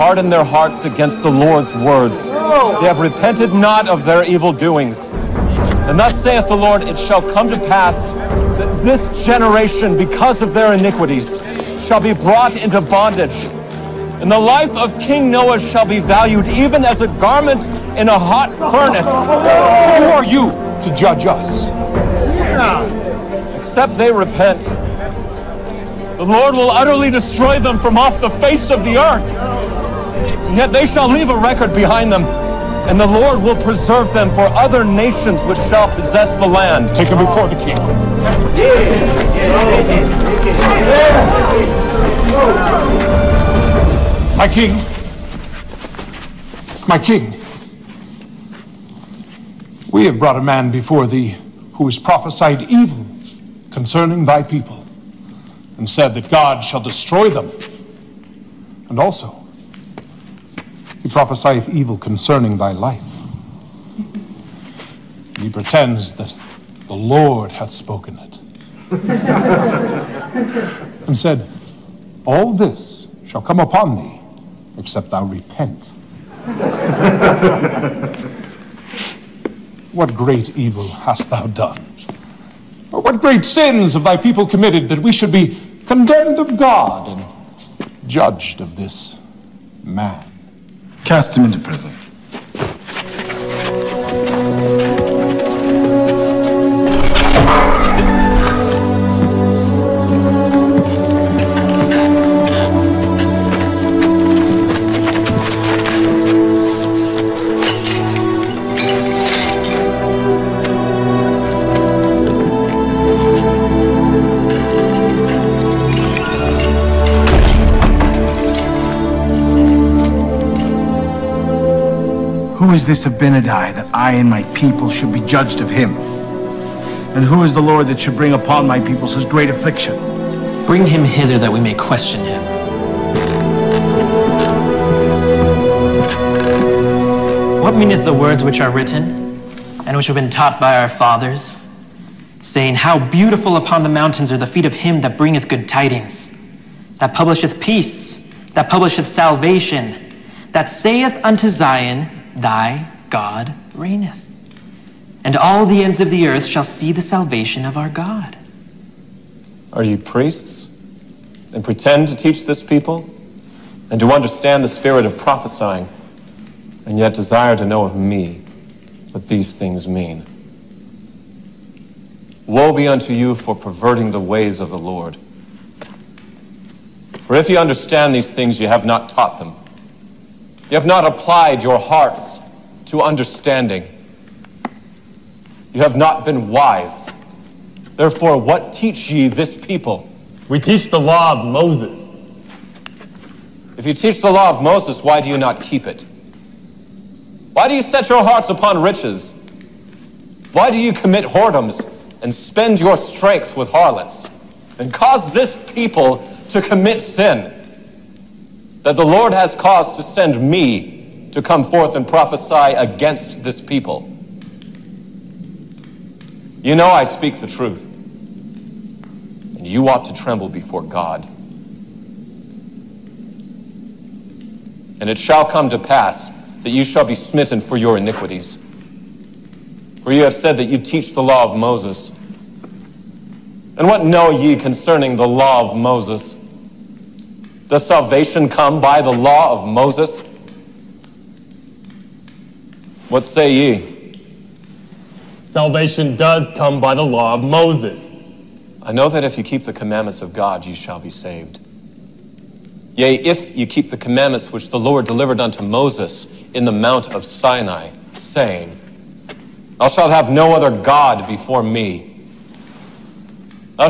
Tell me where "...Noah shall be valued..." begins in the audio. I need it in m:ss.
0:15.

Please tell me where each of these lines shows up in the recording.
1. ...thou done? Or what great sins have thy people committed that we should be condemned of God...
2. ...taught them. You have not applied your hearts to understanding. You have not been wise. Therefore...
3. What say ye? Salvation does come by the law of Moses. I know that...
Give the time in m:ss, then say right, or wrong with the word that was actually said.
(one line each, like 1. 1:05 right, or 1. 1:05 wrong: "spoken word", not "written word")
1. 1:21 right
2. 2:59 right
3. 4:03 right.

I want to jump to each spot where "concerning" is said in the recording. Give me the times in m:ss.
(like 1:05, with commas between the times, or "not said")
0:53, 1:01, 3:54.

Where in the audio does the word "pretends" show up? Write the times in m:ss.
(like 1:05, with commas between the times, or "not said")
1:05, 2:41.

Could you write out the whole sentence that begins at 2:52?
Woe be unto you for perverting the ways of the Lord.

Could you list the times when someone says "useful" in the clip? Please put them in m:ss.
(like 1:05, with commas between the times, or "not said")
not said.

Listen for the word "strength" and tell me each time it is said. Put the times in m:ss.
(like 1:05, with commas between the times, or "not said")
3:22.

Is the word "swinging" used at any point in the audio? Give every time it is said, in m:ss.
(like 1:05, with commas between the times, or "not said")
not said.